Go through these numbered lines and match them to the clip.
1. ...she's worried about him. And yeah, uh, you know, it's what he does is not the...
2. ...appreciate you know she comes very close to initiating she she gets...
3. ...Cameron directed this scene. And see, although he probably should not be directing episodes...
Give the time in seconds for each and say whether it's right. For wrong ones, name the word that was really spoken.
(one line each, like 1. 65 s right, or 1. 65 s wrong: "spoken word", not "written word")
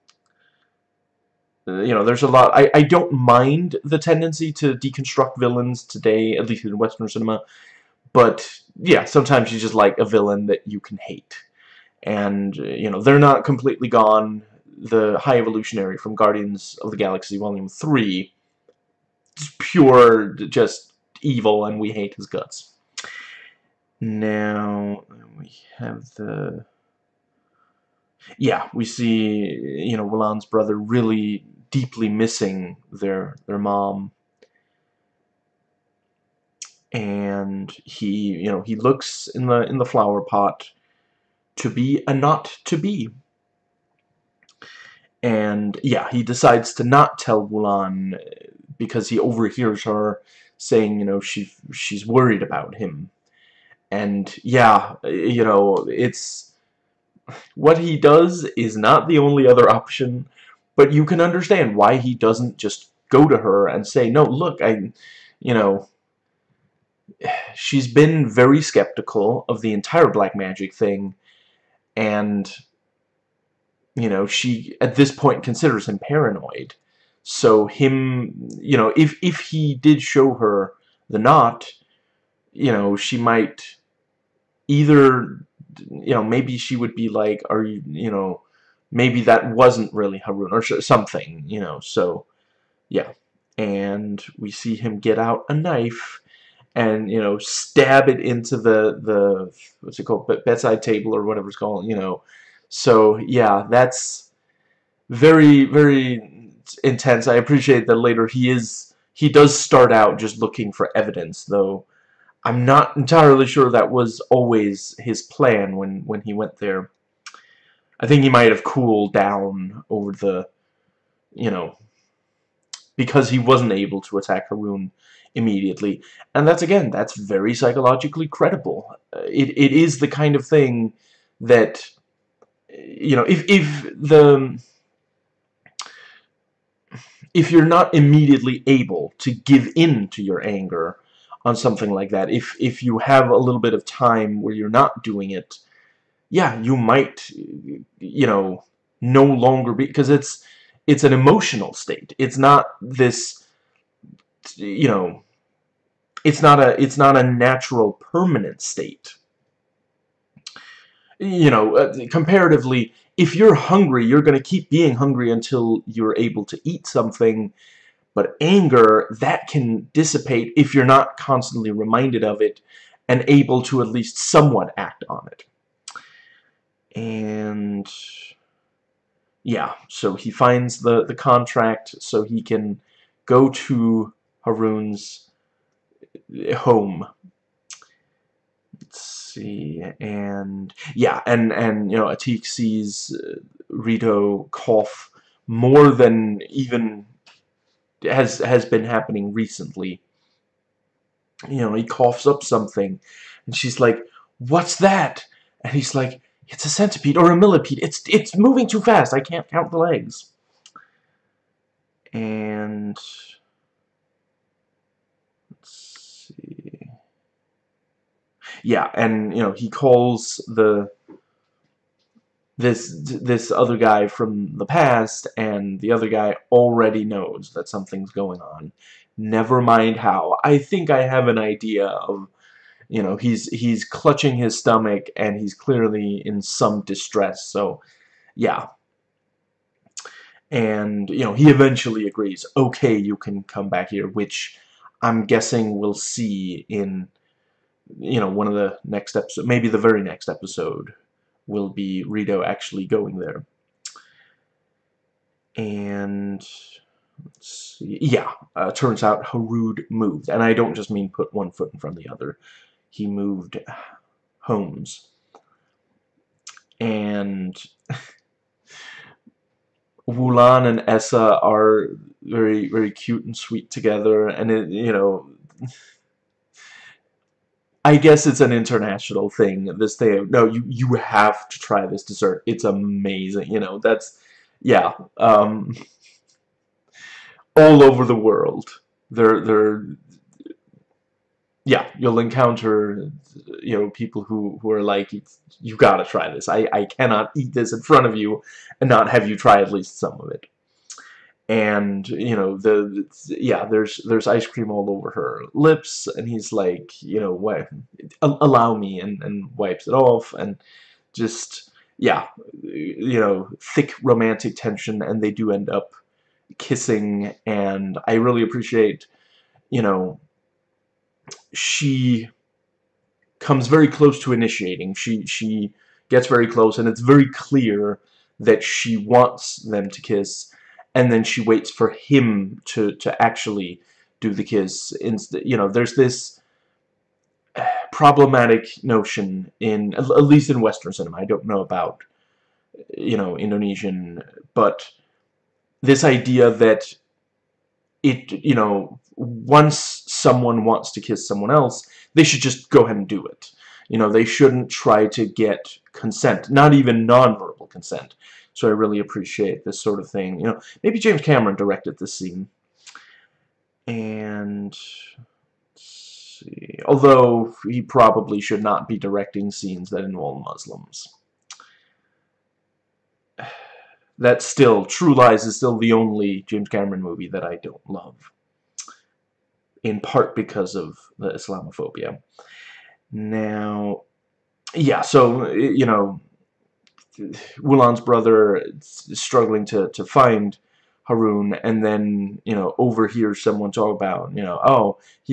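1. 51 s right
2. 318 s right
3. 361 s wrong: "scenes", not "episodes".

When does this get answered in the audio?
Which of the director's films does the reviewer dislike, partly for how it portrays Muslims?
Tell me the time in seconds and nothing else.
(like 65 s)
374 s.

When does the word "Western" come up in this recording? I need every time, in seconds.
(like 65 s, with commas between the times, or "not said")
6 s, 340 s.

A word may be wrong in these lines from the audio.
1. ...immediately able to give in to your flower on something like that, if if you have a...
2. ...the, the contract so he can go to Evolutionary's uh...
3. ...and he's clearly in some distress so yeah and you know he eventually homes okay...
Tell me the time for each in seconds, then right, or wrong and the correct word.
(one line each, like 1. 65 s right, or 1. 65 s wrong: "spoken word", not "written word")
1. 137 s wrong: "anger", not "flower"
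2. 180 s wrong: "Harun", not "Evolutionary"
3. 235 s wrong: "agrees", not "homes".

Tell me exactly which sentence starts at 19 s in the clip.
It's pure, just evil, and we hate his guts.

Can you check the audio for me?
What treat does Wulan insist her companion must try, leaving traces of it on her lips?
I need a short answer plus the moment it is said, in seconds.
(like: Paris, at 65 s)
ice cream, at 304 s.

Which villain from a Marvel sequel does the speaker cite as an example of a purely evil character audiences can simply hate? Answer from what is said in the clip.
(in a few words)
High Evolutionary.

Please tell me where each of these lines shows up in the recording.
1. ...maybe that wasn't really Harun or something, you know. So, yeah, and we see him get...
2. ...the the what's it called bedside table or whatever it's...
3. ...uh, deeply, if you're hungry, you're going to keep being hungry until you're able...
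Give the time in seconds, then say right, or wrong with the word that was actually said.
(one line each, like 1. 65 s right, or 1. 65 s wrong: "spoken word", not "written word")
1. 88 s right
2. 98 s right
3. 161 s wrong: "comparatively", not "deeply".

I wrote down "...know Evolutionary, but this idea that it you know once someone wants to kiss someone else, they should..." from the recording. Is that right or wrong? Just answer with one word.
wrong.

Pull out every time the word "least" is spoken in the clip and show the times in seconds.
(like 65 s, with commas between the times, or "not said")
6 s, 173 s, 299 s, 340 s.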